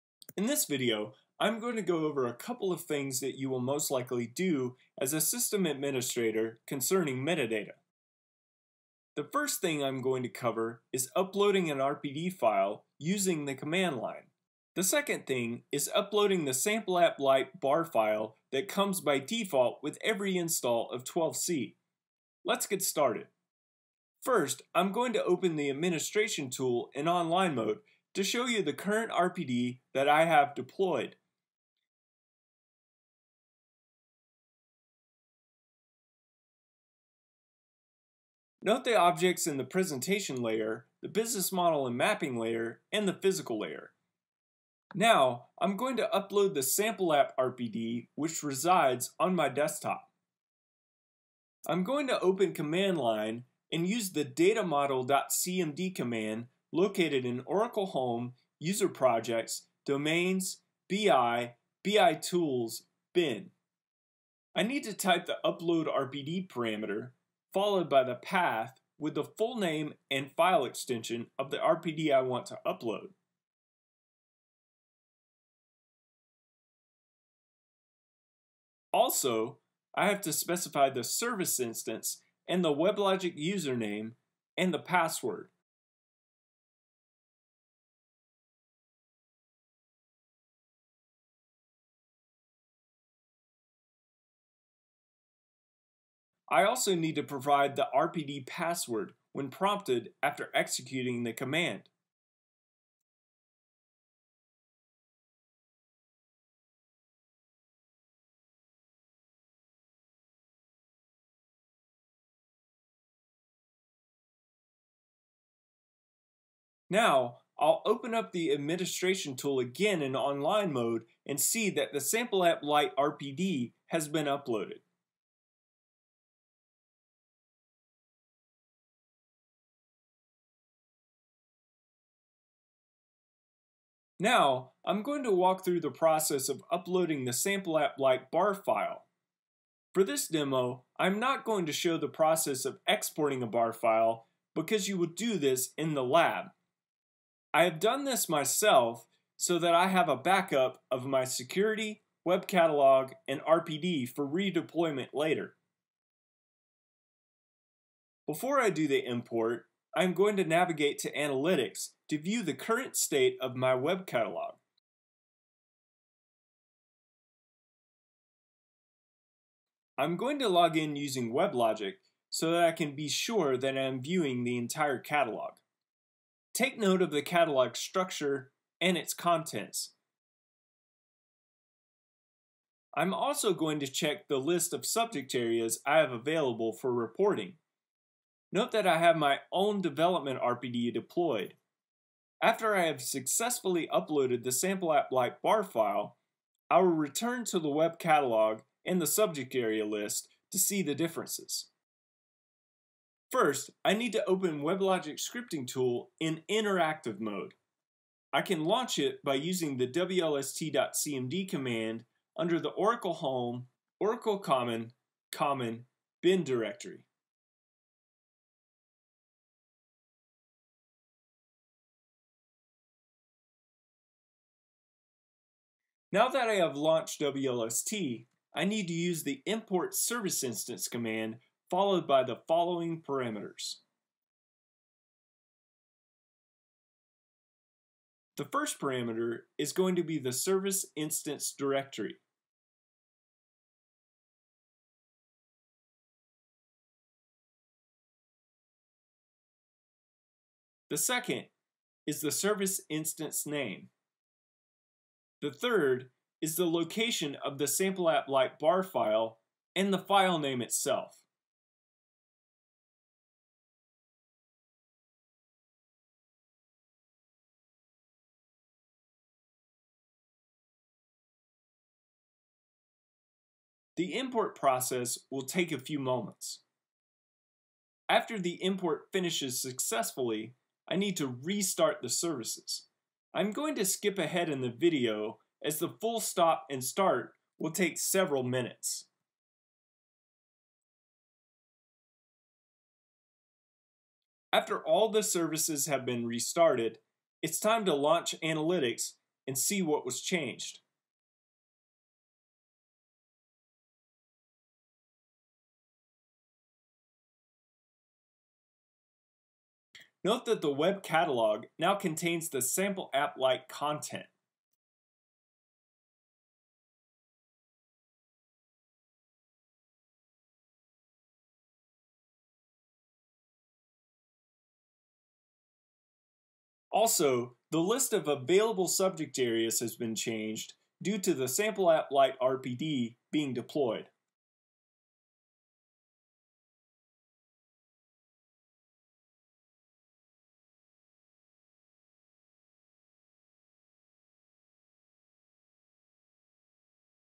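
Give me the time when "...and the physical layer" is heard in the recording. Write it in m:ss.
0:42.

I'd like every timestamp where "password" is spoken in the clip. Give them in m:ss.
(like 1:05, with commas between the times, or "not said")
1:24, 1:38.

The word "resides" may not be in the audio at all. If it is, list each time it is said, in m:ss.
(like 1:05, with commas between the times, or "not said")
0:48.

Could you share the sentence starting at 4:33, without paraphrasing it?
The import process will take a few moments.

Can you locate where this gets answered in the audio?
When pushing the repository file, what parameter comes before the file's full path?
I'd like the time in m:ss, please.
1:05.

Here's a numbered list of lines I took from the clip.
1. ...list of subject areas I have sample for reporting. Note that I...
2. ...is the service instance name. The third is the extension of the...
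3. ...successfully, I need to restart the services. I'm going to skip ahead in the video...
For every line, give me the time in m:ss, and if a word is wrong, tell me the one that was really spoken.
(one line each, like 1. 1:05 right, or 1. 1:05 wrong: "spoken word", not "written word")
1. 3:04 wrong: "available", not "sample"
2. 4:12 wrong: "location", not "extension"
3. 4:39 right.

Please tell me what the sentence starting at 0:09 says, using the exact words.
The first thing I'm going to cover is uploading an RPD file using the command line.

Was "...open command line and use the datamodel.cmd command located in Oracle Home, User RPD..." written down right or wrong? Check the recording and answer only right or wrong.
wrong.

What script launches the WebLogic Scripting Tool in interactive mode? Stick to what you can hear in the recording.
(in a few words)
wlst.cmd.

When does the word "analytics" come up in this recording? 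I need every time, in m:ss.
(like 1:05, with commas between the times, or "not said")
2:41, 4:58.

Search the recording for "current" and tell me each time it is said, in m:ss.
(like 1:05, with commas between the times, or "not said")
0:28, 2:42.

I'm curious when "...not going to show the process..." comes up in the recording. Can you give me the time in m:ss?
2:21.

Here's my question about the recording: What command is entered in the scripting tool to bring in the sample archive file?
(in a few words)
import service instance.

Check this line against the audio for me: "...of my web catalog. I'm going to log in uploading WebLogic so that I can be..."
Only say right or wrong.
wrong.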